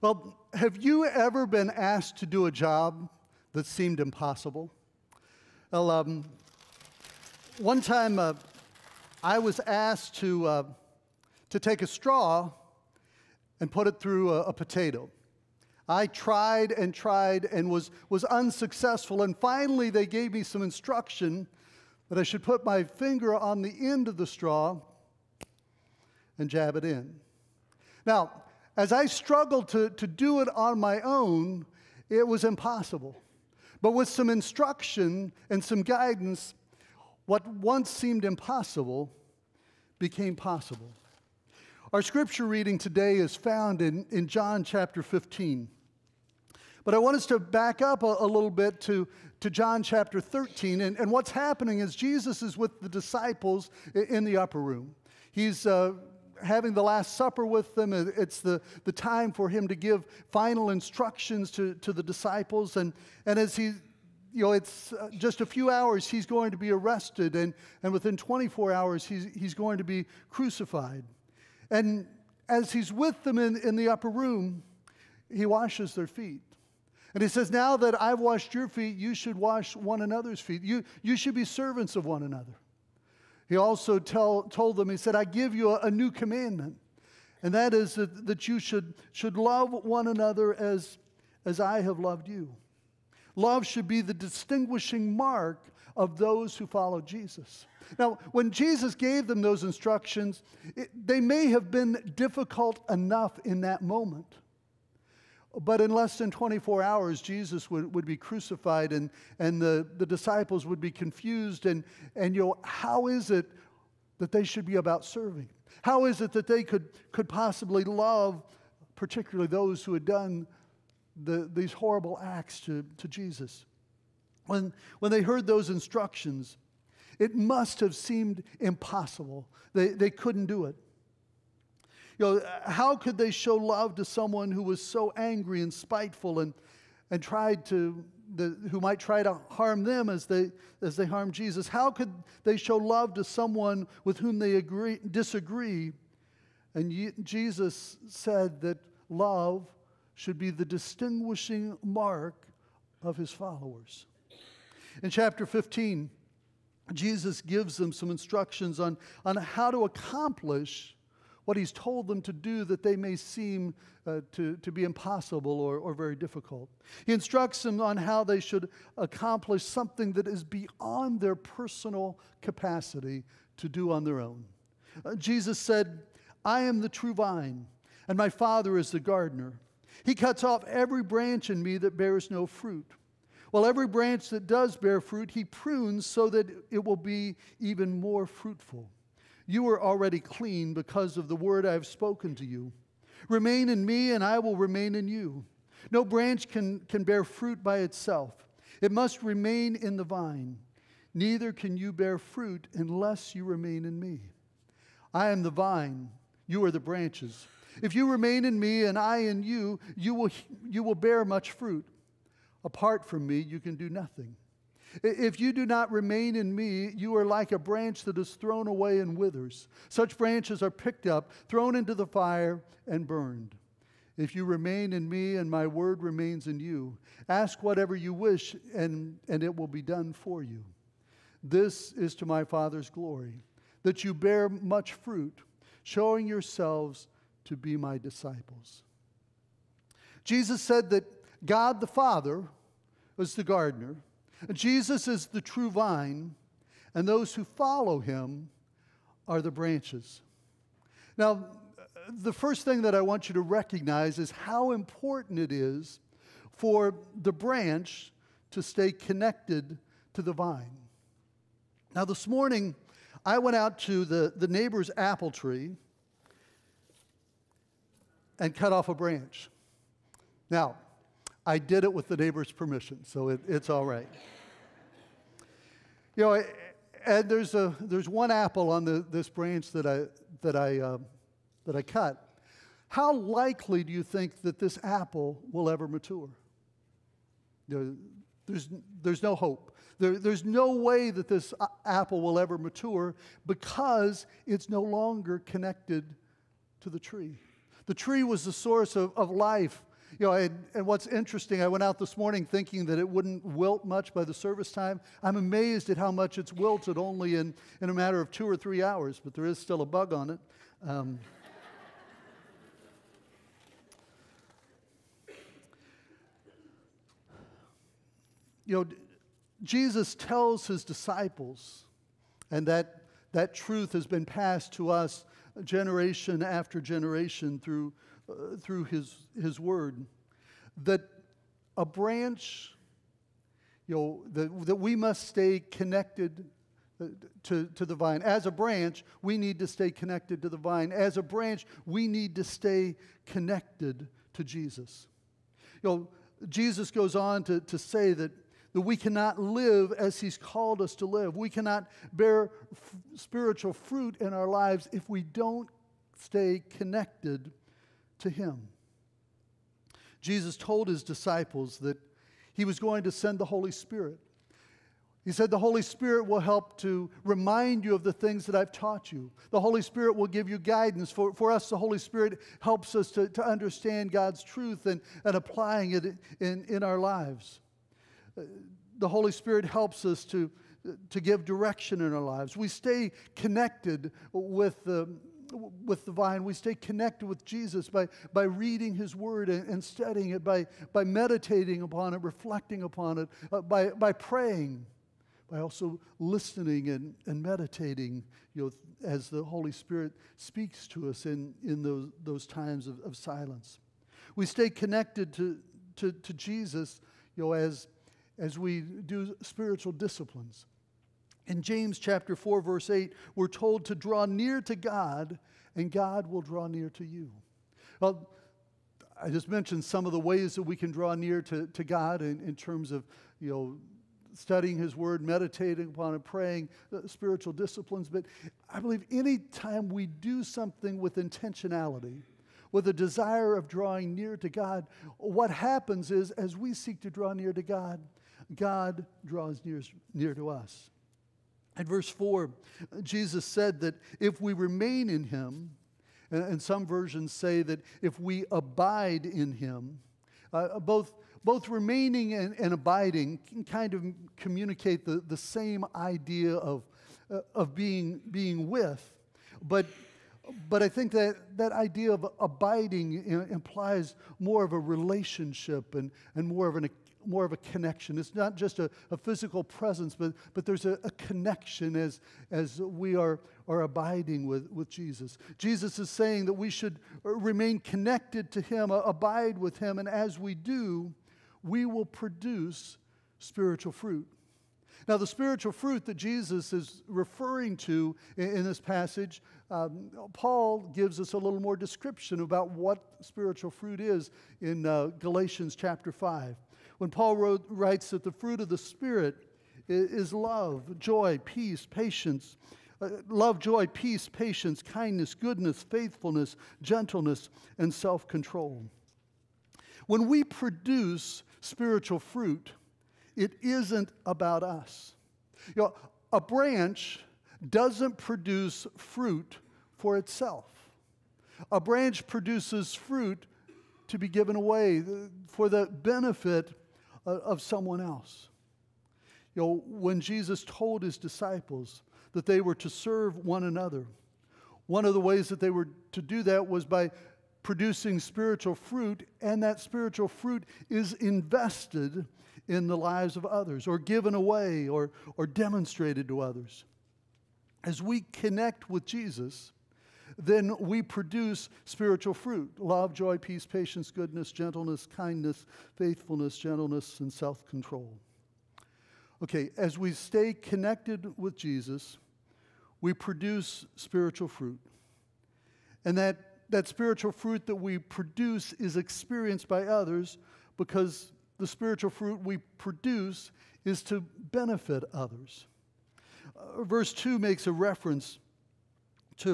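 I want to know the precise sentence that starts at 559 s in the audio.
Okay, as we stay connected with Jesus, we produce spiritual fruit.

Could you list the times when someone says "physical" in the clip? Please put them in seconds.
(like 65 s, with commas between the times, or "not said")
469 s.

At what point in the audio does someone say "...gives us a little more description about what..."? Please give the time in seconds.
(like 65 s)
490 s.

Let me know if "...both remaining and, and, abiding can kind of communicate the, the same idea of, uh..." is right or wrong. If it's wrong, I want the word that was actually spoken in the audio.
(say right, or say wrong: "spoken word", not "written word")
right.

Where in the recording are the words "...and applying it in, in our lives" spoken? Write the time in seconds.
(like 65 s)
375 s.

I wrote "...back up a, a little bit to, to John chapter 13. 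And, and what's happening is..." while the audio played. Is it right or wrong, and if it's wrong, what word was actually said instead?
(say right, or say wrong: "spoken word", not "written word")
right.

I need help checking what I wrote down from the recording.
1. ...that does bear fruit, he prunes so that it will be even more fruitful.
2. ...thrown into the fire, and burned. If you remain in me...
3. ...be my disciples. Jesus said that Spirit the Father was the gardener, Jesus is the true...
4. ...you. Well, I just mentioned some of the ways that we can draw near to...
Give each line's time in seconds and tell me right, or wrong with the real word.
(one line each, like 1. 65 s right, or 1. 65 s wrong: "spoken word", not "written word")
1. 184 s right
2. 221 s right
3. 237 s wrong: "God", not "Spirit"
4. 417 s right.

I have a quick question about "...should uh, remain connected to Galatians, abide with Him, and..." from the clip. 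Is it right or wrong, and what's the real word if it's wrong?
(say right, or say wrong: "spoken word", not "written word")
wrong: "Him", not "Galatians".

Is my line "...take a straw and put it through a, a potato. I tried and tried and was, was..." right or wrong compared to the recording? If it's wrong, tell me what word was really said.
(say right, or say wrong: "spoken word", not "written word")
right.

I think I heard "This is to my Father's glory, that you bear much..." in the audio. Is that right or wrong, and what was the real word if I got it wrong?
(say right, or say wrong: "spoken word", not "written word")
right.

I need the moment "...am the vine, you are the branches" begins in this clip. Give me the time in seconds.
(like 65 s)
205 s.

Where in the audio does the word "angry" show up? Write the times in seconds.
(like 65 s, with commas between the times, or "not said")
135 s.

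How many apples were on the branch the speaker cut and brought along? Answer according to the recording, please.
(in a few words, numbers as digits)
1.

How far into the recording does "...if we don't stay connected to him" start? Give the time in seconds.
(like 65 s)
354 s.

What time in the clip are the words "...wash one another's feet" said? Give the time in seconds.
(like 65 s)
79 s.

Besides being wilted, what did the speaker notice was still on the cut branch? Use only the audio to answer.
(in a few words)
A bug.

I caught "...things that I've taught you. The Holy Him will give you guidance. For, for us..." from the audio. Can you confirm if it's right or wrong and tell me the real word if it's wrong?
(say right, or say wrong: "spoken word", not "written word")
wrong: "Spirit", not "Him".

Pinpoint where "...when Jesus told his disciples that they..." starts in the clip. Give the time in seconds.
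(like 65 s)
529 s.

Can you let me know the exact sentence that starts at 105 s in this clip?
But in less than 24 hours, Jesus would, would be crucified and, and the, the disciples would be confused.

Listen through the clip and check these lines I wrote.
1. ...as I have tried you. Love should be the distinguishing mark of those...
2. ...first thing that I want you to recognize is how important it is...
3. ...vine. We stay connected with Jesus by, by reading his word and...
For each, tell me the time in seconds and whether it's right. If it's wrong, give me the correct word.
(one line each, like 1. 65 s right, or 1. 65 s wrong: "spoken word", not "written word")
1. 91 s wrong: "loved", not "tried"
2. 252 s right
3. 386 s right.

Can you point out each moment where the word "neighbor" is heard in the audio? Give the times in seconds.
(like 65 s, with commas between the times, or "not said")
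264 s, 272 s.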